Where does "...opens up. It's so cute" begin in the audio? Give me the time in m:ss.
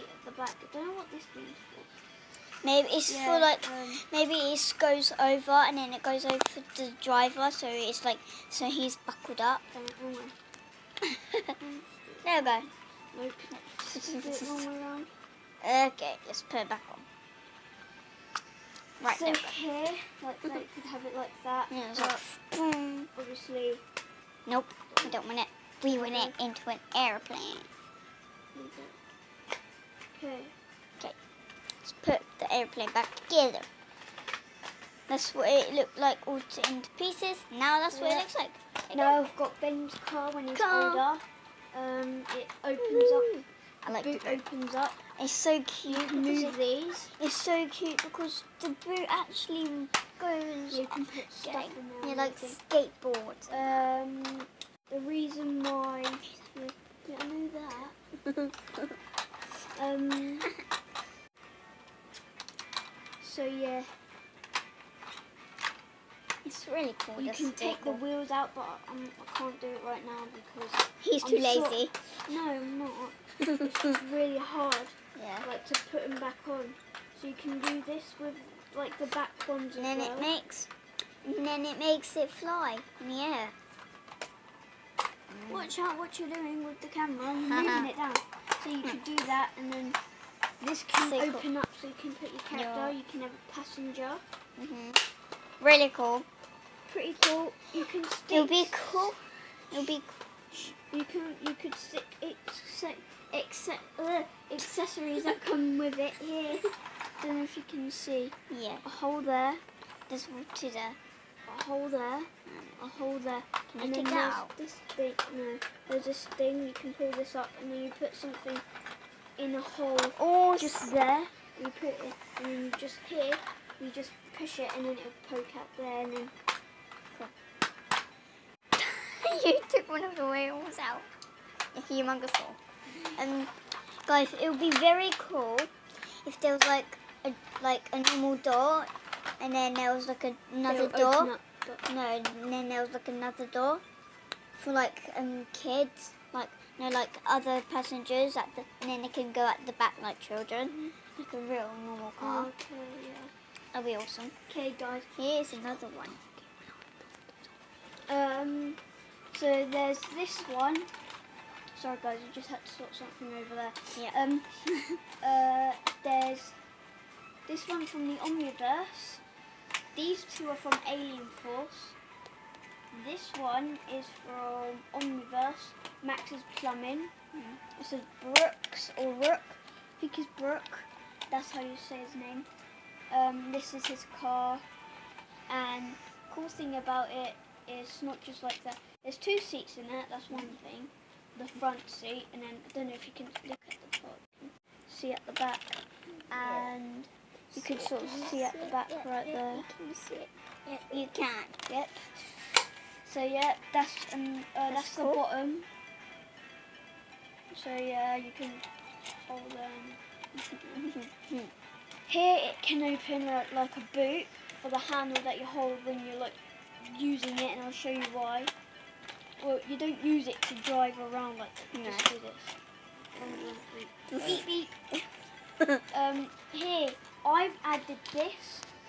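0:44.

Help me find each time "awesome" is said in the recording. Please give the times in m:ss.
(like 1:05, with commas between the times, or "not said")
2:33.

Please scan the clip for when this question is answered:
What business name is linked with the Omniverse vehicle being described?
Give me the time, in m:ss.
2:56.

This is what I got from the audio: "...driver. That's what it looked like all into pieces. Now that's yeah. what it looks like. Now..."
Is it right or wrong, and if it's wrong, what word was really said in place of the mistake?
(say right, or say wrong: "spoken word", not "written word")
wrong: "together", not "driver".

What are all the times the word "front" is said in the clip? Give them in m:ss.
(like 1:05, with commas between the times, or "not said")
3:11.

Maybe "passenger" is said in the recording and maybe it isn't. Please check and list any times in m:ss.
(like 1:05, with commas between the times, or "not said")
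1:33, 2:27.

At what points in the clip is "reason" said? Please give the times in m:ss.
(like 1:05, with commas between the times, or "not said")
0:55.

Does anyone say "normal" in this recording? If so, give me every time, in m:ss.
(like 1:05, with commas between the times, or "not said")
2:18, 2:31.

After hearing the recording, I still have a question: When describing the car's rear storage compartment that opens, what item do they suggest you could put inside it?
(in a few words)
Skateboard.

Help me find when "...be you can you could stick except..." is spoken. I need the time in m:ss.
1:39.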